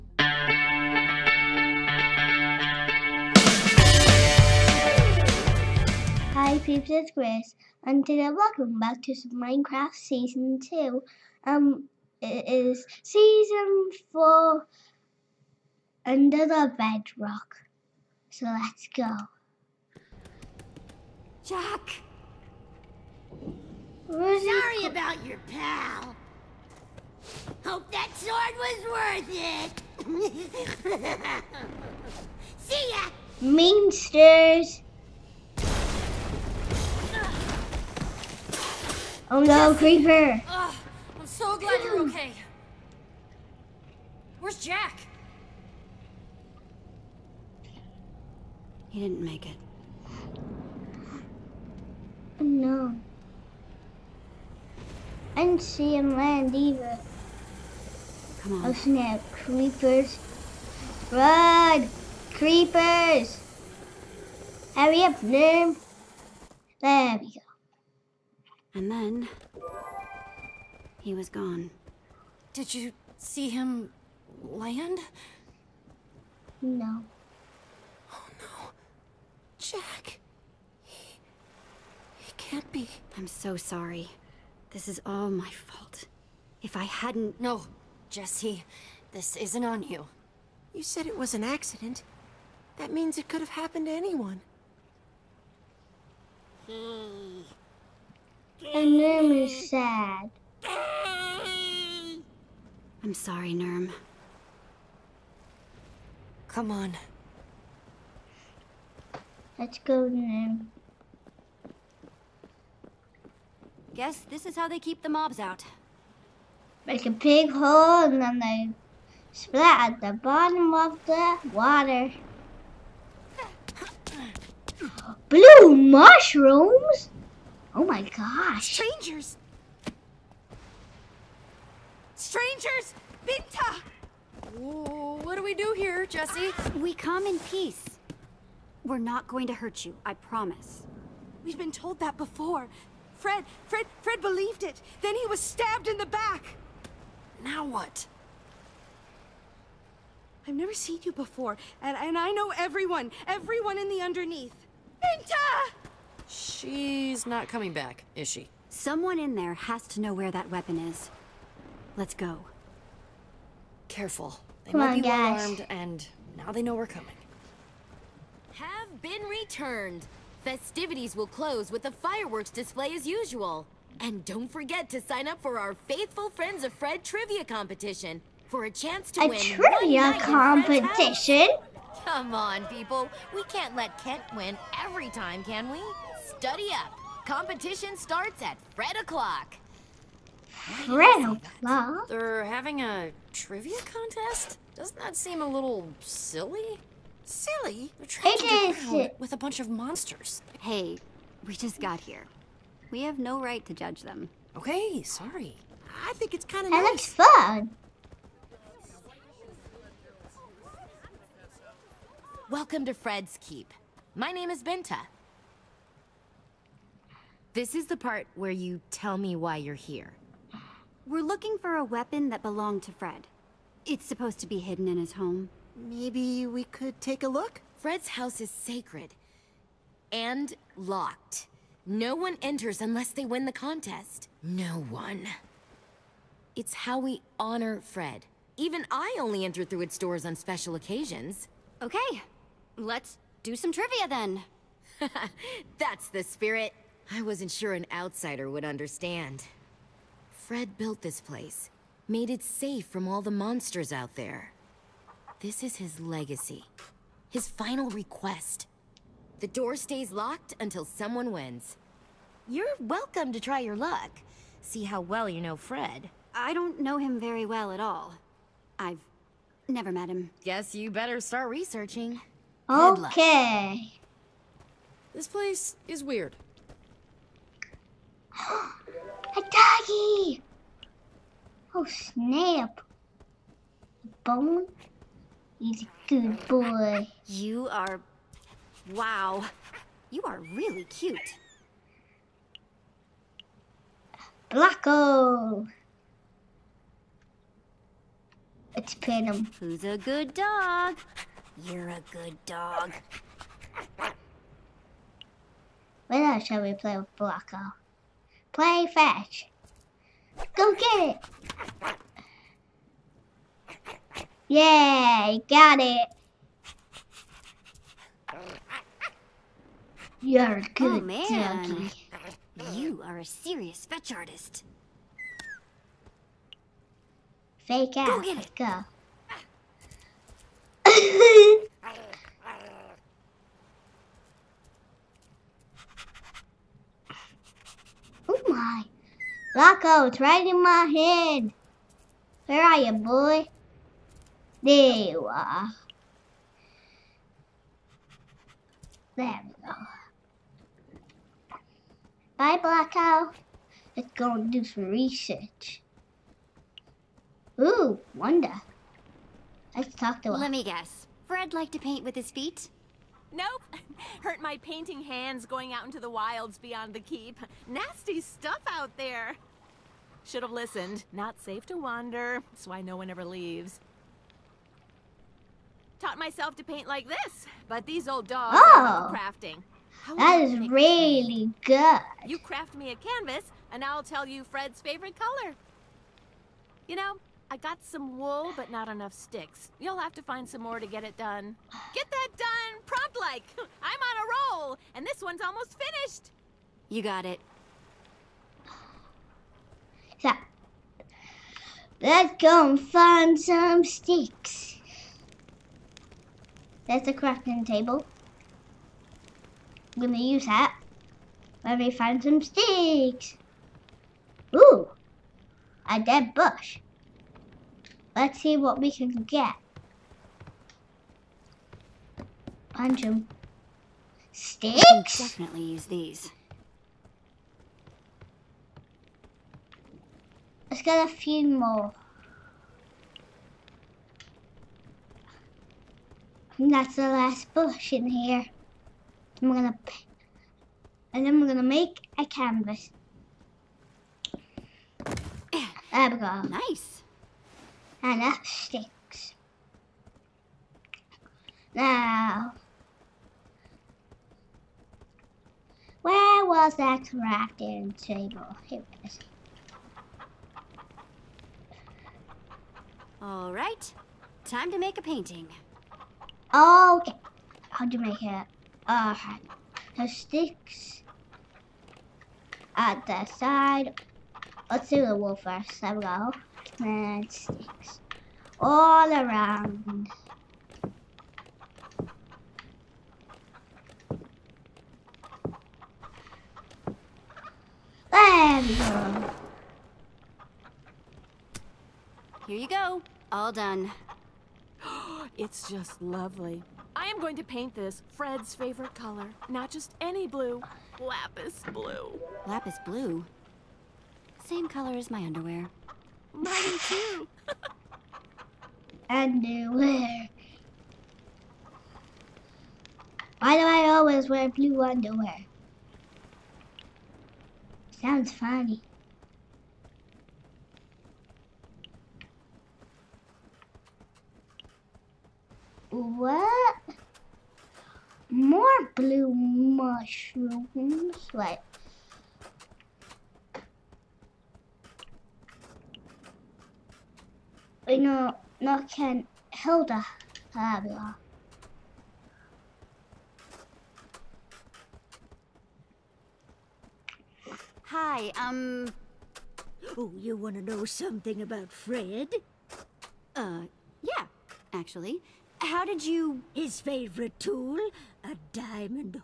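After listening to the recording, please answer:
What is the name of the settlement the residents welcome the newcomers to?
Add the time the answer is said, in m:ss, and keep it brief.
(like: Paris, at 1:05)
Fred's Keep, at 3:32.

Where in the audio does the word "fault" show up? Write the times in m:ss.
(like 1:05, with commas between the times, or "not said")
1:25.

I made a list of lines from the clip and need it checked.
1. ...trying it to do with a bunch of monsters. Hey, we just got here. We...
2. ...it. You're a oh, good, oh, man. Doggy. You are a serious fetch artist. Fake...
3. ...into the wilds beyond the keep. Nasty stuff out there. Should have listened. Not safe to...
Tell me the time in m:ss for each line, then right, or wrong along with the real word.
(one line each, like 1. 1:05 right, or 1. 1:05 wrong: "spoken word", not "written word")
1. 3:18 right
2. 5:15 right
3. 6:05 right.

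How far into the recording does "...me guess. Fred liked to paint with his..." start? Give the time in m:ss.
6:00.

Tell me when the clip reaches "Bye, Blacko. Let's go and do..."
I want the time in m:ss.
5:52.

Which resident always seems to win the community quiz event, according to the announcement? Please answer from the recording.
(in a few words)
Kent.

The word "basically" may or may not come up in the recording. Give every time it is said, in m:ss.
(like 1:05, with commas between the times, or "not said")
not said.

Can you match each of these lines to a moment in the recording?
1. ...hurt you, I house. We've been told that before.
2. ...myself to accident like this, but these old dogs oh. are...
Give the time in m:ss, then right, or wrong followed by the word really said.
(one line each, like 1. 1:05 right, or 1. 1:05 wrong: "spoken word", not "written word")
1. 2:19 wrong: "promise", not "house"
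2. 6:16 wrong: "paint", not "accident".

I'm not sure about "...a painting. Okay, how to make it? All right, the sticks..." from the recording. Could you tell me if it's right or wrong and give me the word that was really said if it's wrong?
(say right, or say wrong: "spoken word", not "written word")
right.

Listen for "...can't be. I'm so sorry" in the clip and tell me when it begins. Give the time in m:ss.
1:22.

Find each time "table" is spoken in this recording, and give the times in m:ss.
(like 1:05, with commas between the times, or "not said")
6:47, 7:37.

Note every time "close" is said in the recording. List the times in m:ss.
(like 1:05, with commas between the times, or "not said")
2:51.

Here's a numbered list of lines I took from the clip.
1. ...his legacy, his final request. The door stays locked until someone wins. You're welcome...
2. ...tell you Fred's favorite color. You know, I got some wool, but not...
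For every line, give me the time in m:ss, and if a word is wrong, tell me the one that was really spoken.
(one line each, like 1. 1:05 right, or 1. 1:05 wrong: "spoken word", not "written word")
1. 4:15 right
2. 6:24 right.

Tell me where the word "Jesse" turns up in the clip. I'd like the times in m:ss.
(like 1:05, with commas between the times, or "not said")
1:28, 2:16.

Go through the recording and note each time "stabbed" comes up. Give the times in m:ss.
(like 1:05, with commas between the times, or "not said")
2:25.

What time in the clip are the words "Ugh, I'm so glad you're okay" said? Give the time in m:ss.
0:40.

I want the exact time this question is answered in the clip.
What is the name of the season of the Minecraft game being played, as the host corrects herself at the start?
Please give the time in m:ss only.
0:16.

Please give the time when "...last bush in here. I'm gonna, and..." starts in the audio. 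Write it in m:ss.
7:17.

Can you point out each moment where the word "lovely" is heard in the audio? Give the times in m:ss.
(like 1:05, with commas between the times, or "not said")
8:16.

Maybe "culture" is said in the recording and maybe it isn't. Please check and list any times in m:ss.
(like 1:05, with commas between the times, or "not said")
not said.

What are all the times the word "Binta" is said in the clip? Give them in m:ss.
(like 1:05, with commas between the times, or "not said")
2:13, 2:35, 3:34.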